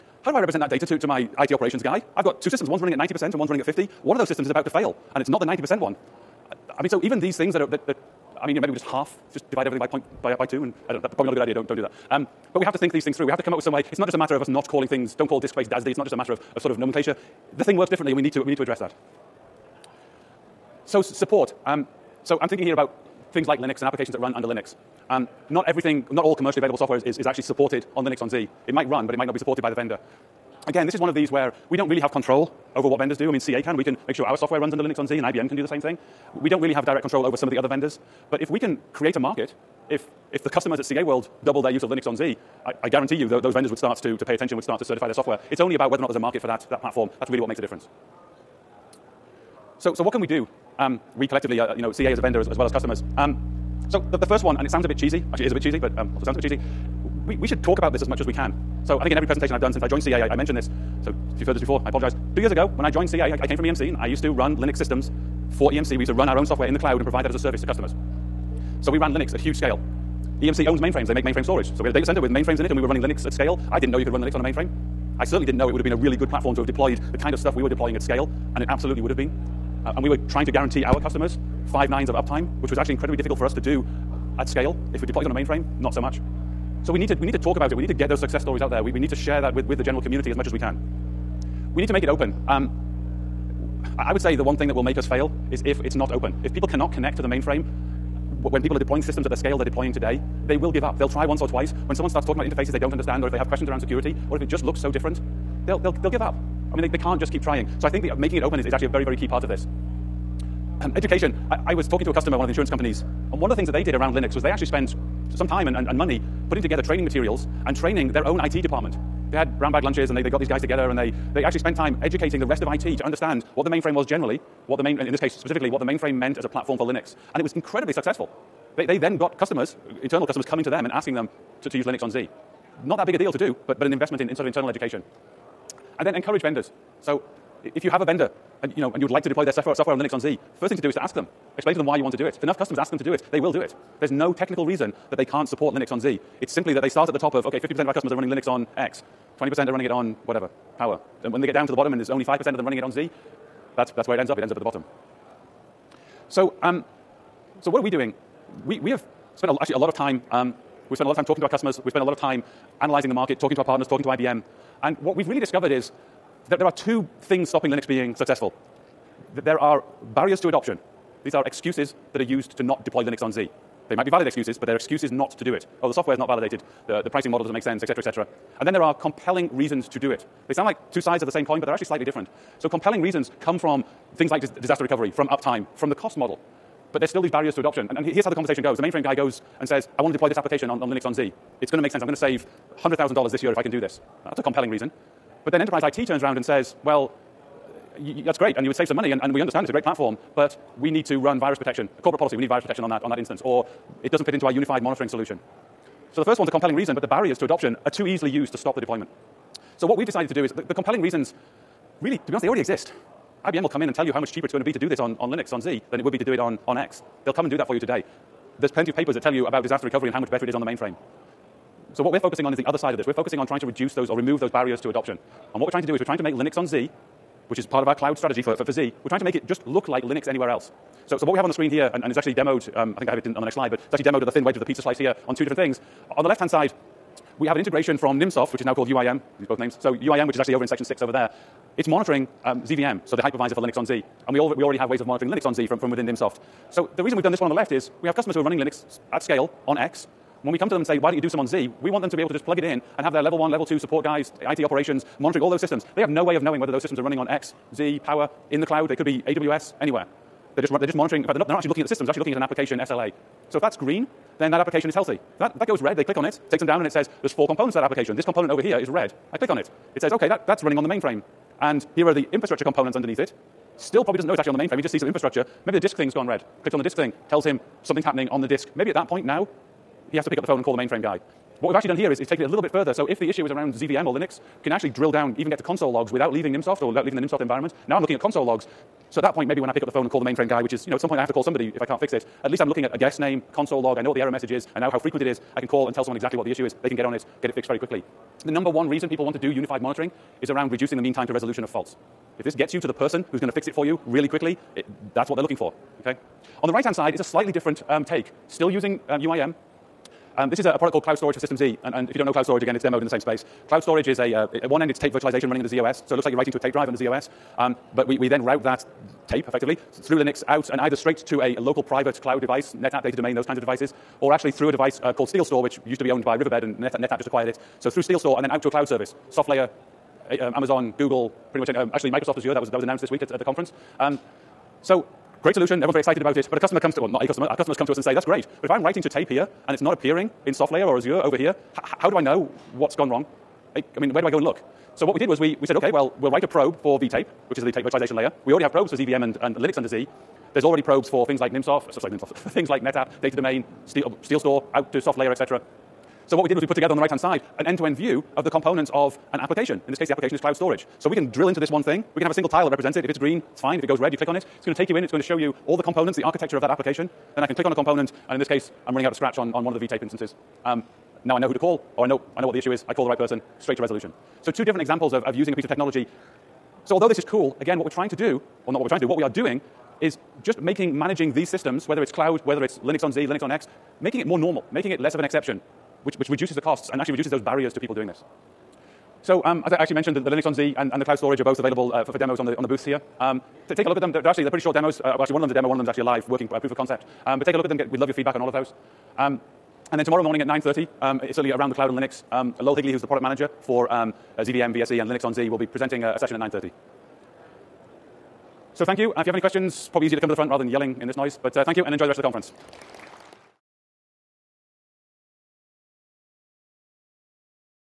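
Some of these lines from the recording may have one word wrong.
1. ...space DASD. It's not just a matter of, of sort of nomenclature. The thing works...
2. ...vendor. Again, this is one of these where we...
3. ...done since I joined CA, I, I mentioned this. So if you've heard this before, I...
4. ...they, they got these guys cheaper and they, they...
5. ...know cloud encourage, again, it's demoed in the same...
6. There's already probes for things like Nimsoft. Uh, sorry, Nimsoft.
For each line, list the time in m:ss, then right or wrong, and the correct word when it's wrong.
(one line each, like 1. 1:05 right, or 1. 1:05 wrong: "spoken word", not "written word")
1. 0:15 right
2. 0:29 right
3. 0:59 right
4. 2:00 wrong: "together", not "cheaper"
5. 5:12 wrong: "storage", not "encourage"
6. 5:50 right.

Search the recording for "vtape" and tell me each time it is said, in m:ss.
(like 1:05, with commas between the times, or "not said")
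5:46, 6:09.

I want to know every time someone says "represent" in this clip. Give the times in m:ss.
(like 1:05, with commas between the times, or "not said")
0:00, 6:02.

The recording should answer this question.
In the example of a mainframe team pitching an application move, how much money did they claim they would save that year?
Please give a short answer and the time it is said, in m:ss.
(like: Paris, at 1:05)
$100,000, at 3:12.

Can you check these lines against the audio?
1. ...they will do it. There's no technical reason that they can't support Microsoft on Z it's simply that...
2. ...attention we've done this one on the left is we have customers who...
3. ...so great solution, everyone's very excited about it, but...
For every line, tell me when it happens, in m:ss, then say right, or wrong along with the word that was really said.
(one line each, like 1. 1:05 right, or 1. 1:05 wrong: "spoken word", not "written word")
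1. 2:23 wrong: "Linux", not "Microsoft"
2. 4:07 wrong: "reason", not "attention"
3. 5:34 right.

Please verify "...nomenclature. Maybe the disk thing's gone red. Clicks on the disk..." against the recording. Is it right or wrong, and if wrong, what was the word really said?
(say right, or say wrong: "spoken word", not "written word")
wrong: "infrastructure", not "nomenclature".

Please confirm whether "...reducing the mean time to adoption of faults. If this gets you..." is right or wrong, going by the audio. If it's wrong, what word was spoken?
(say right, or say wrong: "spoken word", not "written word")
wrong: "resolution", not "adoption".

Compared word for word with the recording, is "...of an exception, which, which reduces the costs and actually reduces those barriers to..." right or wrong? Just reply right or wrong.
right.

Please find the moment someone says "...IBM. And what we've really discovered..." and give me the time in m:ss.
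2:44.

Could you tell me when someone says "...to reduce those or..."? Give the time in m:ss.
3:43.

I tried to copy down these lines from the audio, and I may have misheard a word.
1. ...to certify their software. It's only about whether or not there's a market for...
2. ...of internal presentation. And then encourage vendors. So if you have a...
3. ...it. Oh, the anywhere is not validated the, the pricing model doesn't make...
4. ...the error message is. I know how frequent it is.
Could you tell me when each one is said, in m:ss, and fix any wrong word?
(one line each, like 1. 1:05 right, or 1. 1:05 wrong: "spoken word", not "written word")
1. 0:44 right
2. 2:14 wrong: "education", not "presentation"
3. 2:55 wrong: "software", not "anywhere"
4. 4:54 right.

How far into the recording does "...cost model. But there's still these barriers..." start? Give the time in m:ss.
3:05.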